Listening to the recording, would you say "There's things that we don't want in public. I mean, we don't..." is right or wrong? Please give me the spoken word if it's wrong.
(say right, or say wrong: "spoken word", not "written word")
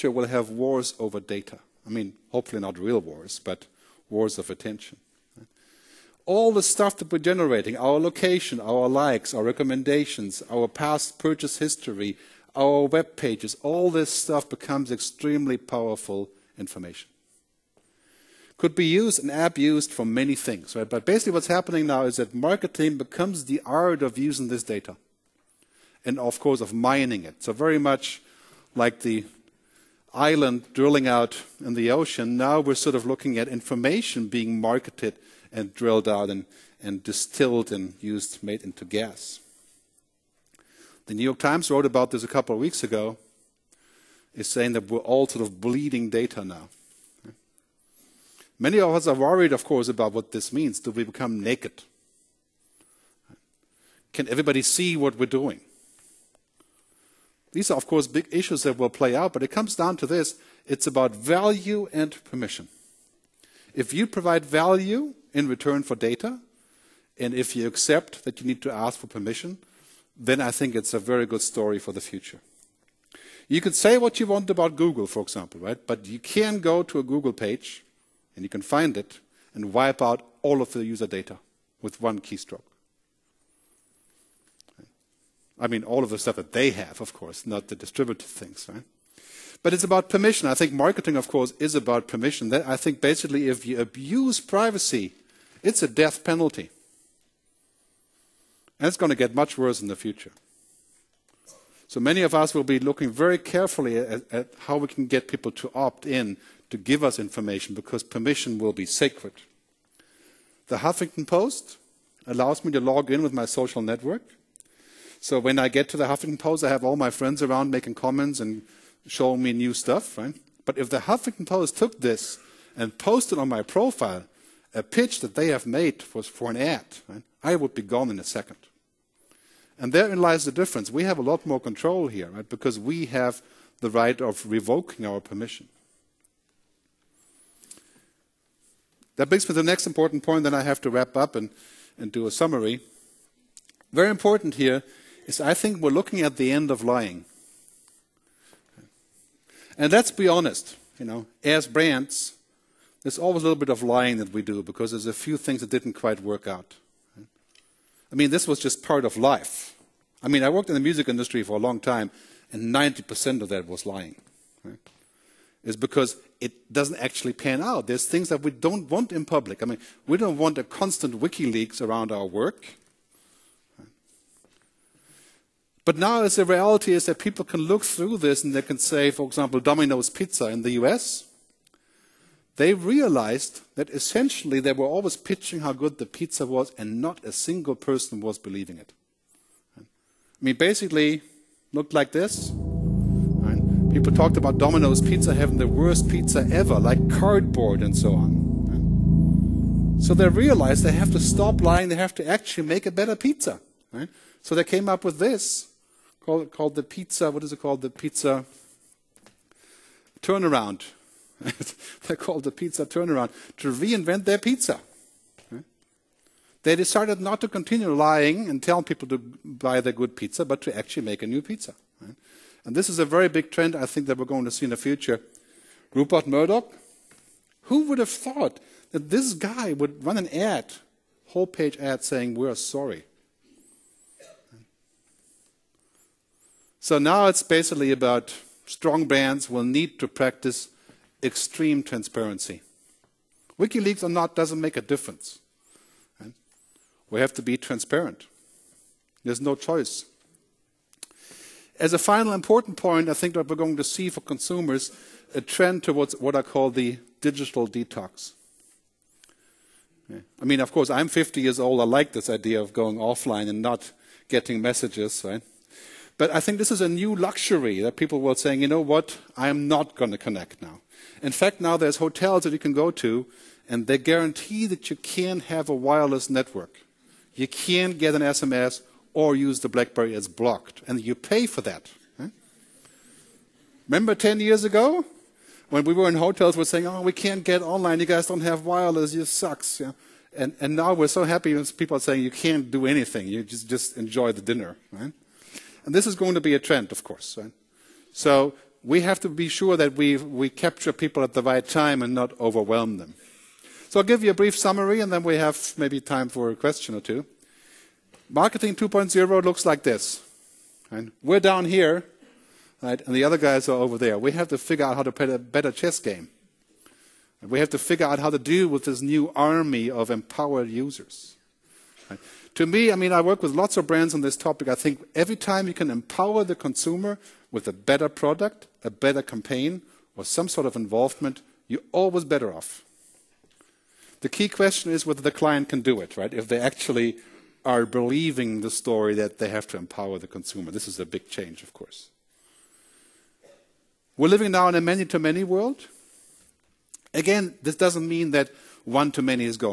right.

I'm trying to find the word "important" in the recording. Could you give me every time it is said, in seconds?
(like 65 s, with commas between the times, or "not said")
139 s, 144 s, 252 s.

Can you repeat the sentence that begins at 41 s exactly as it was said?
The New York Times wrote about this a couple of weeks ago, is saying that we're all sort of bleeding data now.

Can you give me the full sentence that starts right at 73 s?
You could say what you want about Google, for example, right?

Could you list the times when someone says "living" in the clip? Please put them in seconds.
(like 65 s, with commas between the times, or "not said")
344 s.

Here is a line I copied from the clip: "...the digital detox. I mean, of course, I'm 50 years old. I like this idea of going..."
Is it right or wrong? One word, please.
right.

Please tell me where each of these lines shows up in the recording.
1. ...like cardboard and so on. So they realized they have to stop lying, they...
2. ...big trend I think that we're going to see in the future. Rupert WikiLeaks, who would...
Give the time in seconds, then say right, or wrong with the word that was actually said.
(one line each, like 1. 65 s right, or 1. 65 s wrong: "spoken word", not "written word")
1. 196 s right
2. 223 s wrong: "Murdoch", not "WikiLeaks".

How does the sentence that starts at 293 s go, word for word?
You just, just enjoy the dinner.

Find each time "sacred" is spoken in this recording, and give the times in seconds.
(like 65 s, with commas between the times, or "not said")
108 s.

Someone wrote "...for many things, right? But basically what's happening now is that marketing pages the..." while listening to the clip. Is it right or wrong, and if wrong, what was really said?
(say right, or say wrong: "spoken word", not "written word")
wrong: "becomes", not "pages".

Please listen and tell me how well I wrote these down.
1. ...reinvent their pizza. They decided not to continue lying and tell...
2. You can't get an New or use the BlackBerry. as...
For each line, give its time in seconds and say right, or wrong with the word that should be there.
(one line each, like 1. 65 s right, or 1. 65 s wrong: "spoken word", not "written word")
1. 213 s right
2. 277 s wrong: "SMS", not "New".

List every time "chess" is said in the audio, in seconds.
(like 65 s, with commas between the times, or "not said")
315 s.